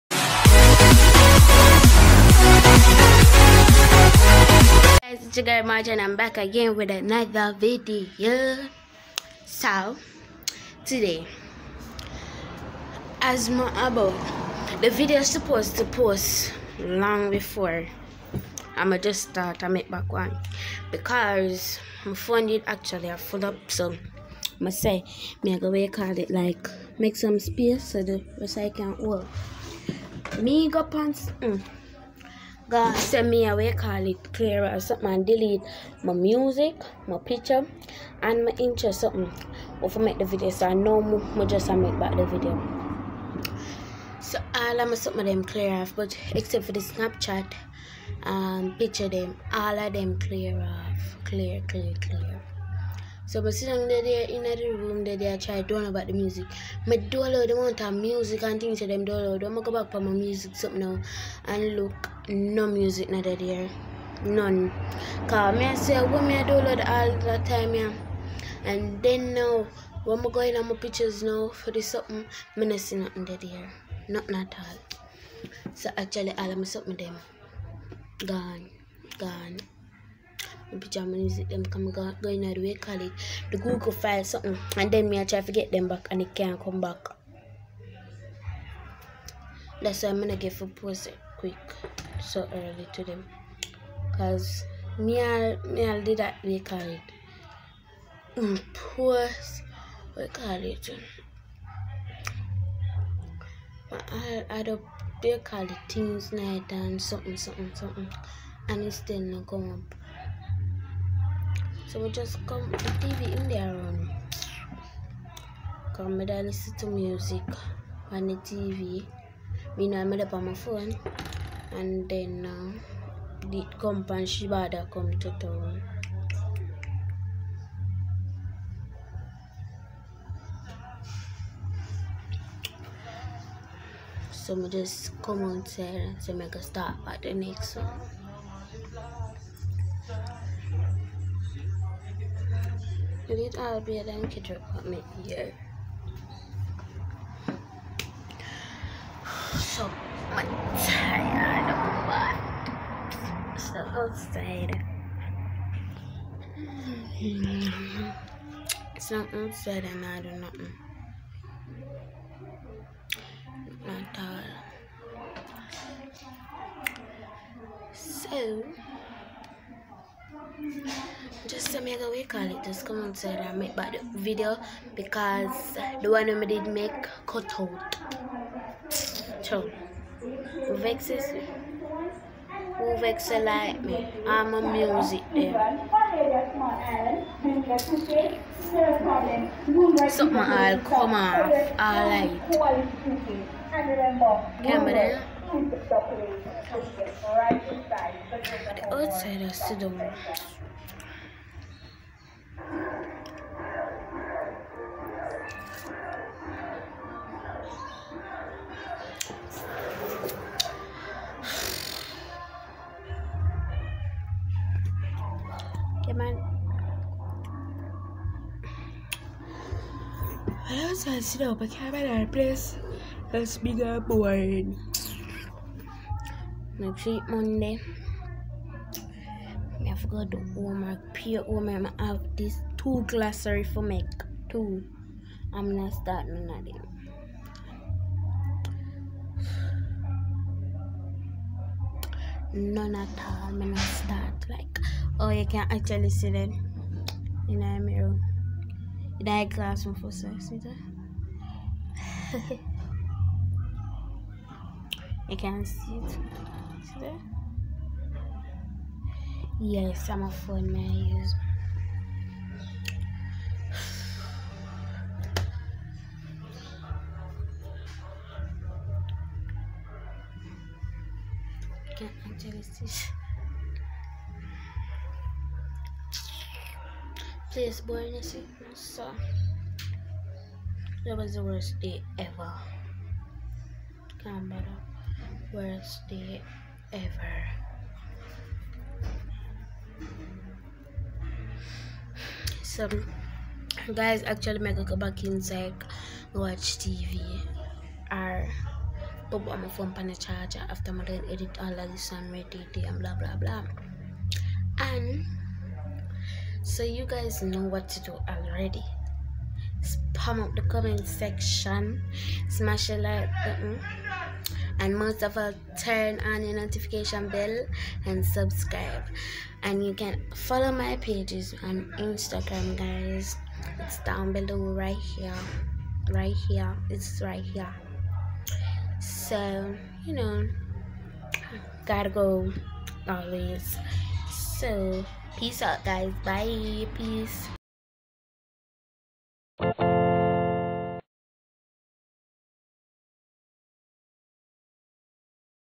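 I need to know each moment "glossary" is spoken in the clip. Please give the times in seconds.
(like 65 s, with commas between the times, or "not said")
233 s.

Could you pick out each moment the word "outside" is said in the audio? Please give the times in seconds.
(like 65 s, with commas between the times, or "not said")
135 s, 173 s, 198 s.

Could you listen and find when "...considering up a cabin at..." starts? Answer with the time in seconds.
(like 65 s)
221 s.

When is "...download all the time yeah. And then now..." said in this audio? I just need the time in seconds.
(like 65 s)
66 s.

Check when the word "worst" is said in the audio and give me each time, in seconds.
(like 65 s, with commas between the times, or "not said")
281 s, 285 s.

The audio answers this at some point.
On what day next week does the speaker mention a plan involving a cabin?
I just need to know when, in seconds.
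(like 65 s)
227 s.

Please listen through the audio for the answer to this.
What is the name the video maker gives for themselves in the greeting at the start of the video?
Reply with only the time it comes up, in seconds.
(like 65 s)
5 s.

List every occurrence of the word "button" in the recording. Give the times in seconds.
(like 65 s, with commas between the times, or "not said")
313 s.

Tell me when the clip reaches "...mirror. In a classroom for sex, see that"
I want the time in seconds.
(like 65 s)
247 s.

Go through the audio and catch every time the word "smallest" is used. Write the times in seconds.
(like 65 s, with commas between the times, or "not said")
not said.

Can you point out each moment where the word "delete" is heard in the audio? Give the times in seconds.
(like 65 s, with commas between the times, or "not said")
35 s.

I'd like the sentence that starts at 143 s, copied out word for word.
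I to be dan ke kitchen apartment here.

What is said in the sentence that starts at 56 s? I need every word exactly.
do download the amount of music and things that them download.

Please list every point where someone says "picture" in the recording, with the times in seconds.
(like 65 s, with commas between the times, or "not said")
37 s, 48 s, 70 s.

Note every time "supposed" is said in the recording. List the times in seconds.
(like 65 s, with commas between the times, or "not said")
15 s.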